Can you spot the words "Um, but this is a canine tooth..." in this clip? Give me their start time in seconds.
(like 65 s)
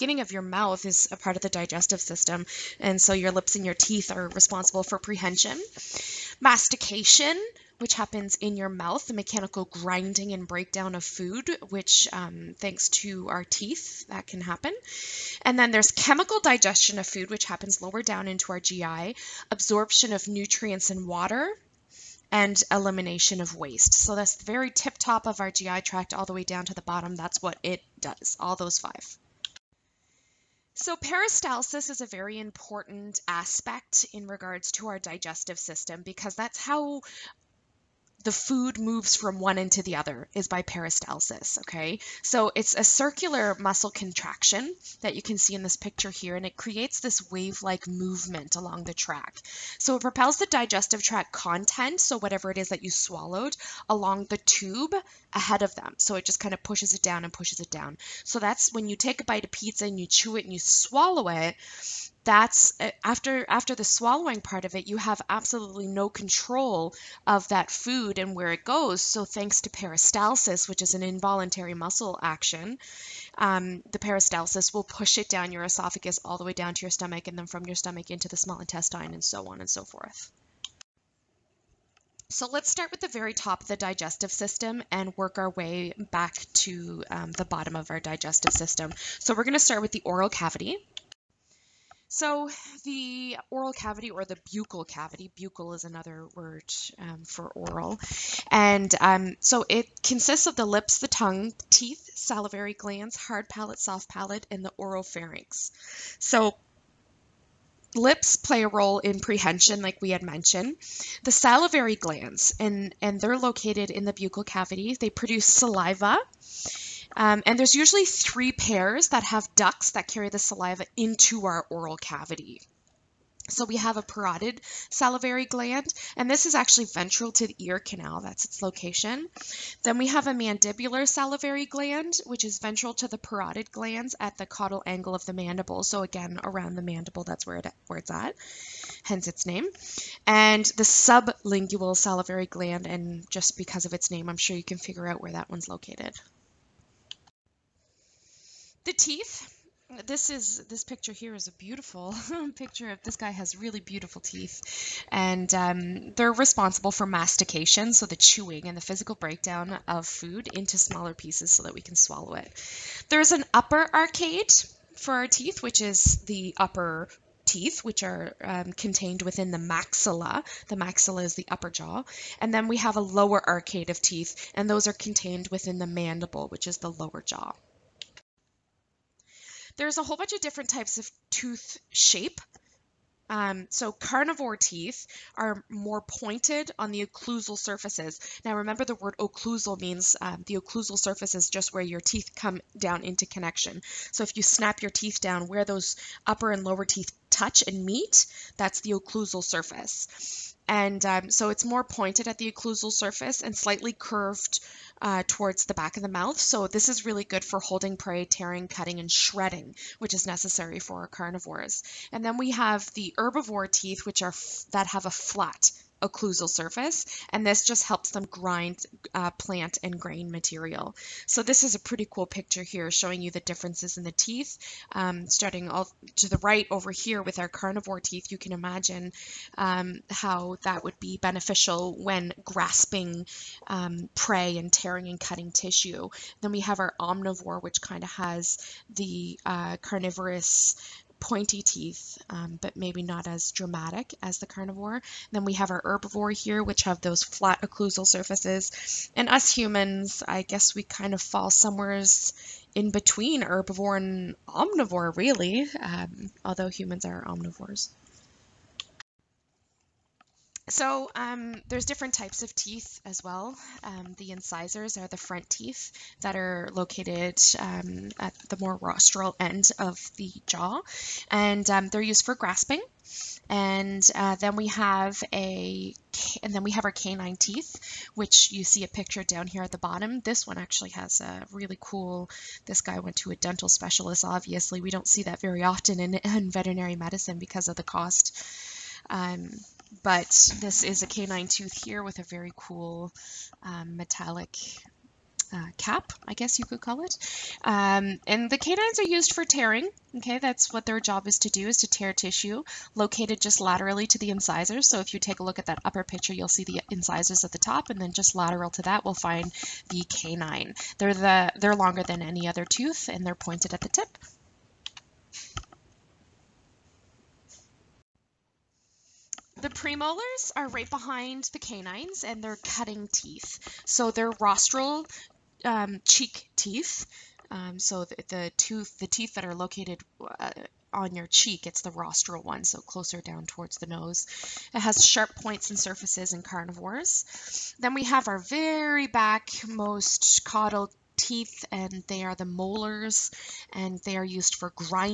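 289 s.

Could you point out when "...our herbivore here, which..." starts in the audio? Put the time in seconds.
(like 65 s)
245 s.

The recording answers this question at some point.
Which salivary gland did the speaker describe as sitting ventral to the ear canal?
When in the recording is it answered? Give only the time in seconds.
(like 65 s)
124 s.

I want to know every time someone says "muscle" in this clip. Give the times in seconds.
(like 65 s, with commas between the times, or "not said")
43 s, 71 s.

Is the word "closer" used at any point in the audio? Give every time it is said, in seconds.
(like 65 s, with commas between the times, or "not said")
332 s.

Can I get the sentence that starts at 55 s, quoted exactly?
So it just kind of pushes it down and pushes it down.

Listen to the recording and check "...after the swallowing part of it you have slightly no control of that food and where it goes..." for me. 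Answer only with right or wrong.
wrong.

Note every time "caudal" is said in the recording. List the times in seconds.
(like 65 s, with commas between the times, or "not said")
134 s, 340 s.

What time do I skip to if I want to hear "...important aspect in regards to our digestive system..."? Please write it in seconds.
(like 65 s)
32 s.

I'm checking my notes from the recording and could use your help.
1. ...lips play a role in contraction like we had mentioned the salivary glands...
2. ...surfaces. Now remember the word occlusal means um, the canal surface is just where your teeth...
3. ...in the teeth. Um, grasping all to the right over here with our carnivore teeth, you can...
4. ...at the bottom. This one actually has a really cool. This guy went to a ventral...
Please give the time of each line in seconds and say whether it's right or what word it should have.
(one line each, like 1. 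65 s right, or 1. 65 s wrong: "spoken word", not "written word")
1. 107 s wrong: "prehension", not "contraction"
2. 187 s wrong: "occlusal", not "canal"
3. 223 s wrong: "starting", not "grasping"
4. 279 s wrong: "dental", not "ventral".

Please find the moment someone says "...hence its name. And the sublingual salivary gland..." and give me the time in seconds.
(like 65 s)
139 s.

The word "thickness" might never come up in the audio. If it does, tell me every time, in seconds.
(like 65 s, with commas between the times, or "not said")
not said.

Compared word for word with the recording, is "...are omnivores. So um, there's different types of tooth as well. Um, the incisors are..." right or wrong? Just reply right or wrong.
wrong.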